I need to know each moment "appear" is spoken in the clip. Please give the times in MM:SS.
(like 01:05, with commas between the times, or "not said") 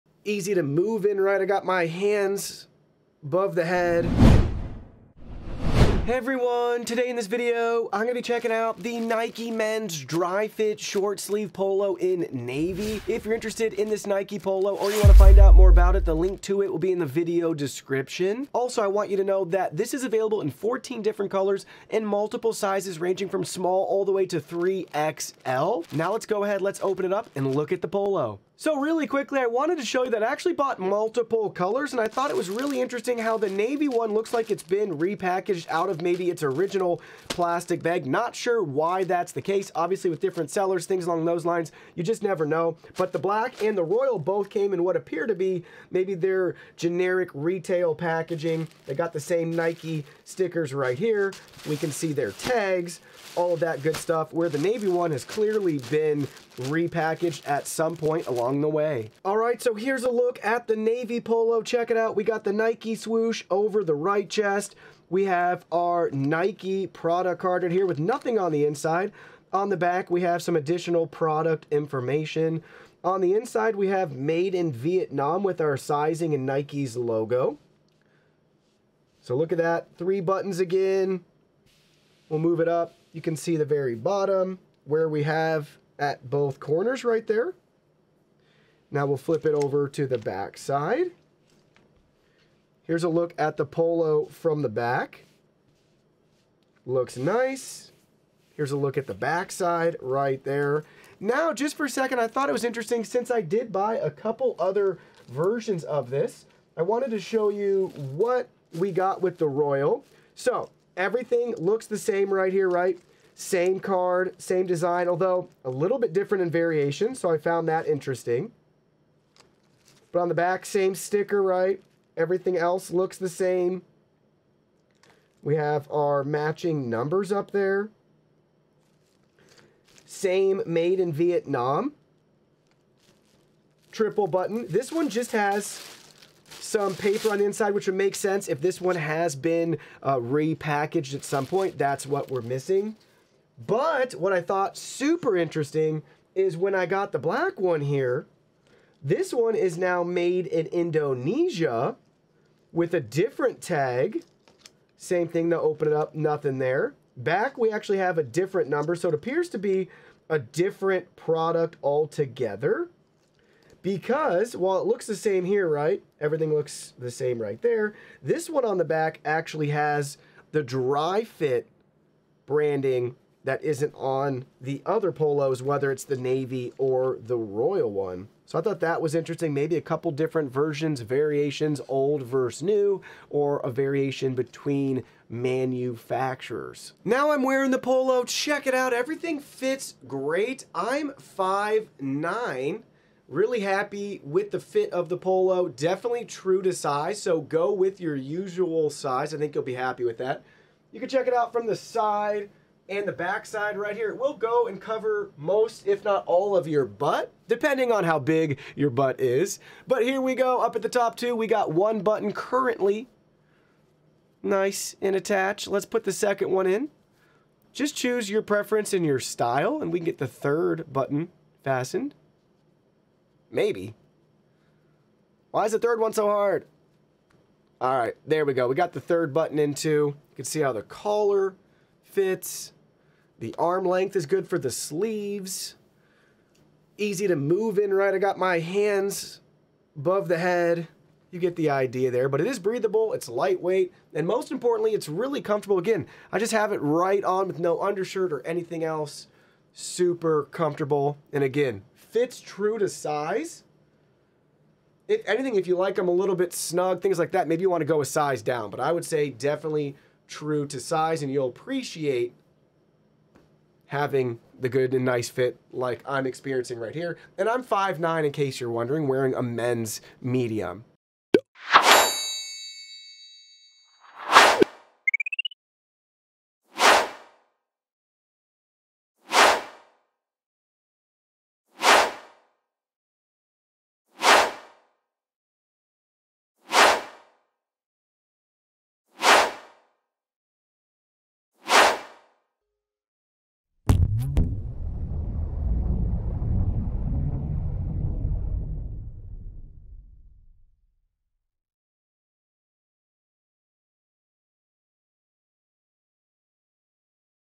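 00:44, 02:39.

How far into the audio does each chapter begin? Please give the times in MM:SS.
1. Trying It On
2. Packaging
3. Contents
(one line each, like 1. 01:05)
1. 03:06
2. 00:28
3. 00:59.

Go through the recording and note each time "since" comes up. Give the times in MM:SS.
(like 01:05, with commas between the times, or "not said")
01:43.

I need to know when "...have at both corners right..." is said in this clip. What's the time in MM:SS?
01:25.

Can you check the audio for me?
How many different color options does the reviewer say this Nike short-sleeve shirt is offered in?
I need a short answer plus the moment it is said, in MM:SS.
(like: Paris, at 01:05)
14, at 00:20.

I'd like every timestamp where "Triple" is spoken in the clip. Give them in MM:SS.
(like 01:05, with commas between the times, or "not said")
02:13.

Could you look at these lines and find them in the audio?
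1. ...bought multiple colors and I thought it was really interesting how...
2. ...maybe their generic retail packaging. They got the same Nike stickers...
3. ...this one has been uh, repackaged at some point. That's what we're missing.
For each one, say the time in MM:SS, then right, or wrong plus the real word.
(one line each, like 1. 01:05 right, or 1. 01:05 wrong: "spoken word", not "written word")
1. 00:30 right
2. 00:45 right
3. 02:18 right.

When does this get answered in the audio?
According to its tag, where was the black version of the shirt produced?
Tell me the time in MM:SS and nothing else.
02:30.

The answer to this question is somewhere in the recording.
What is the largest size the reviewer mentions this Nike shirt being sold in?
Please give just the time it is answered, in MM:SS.
00:24.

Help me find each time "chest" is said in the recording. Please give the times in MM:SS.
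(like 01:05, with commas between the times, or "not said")
01:04.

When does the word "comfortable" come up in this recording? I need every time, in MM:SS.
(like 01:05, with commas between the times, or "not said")
04:05, 04:10.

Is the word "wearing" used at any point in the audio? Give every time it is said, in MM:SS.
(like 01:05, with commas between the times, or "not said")
03:07, 04:29.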